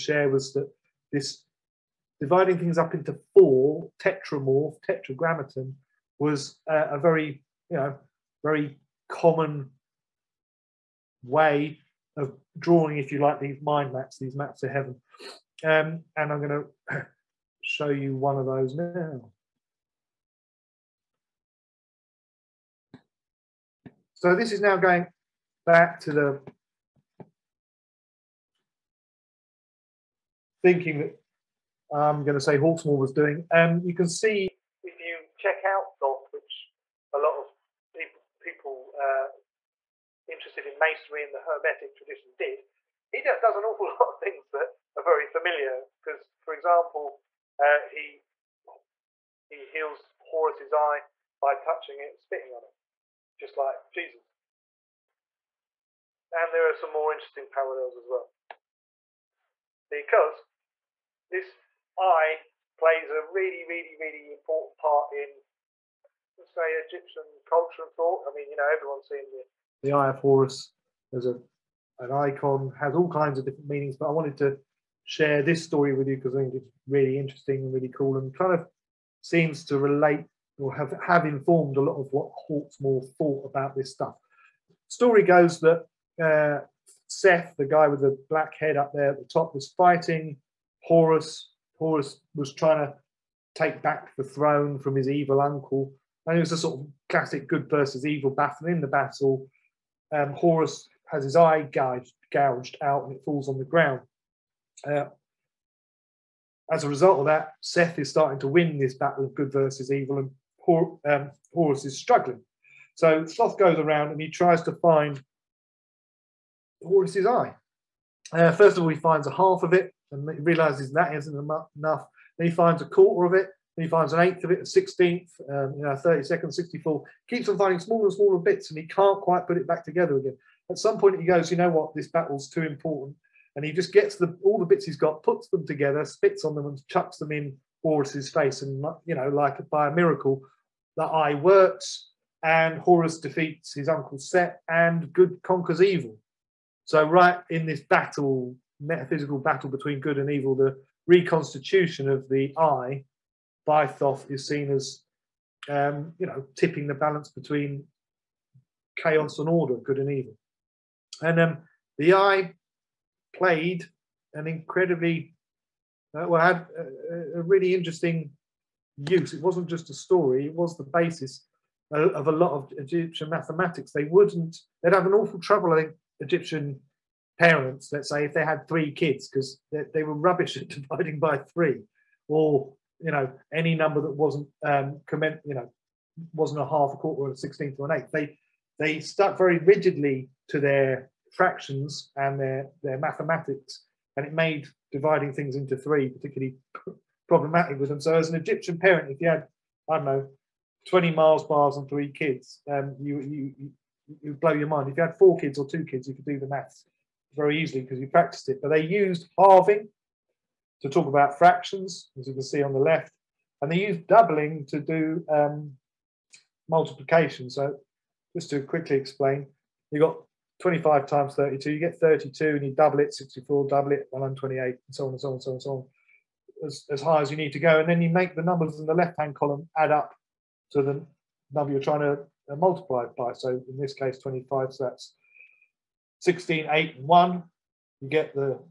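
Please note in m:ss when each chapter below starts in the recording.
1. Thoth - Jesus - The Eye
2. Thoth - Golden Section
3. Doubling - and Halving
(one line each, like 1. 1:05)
1. 0:21
2. 0:58
3. 2:51.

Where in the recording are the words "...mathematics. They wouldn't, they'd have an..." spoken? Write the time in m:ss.
2:53.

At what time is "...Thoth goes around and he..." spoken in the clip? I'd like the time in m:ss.
1:53.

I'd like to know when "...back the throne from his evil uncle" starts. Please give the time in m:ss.
1:33.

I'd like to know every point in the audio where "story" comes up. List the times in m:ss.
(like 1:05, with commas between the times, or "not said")
1:15, 1:24, 2:49.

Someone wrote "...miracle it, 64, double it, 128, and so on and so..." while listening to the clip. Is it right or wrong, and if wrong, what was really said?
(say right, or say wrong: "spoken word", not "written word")
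wrong: "double", not "miracle".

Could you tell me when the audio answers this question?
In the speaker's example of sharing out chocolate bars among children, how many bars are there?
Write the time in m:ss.
3:20.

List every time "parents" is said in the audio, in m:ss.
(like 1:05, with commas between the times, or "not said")
2:57, 3:18.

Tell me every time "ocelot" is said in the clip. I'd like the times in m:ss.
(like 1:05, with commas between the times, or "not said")
not said.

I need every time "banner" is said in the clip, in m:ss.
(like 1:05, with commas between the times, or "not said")
not said.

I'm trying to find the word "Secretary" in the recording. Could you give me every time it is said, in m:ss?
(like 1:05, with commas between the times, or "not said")
not said.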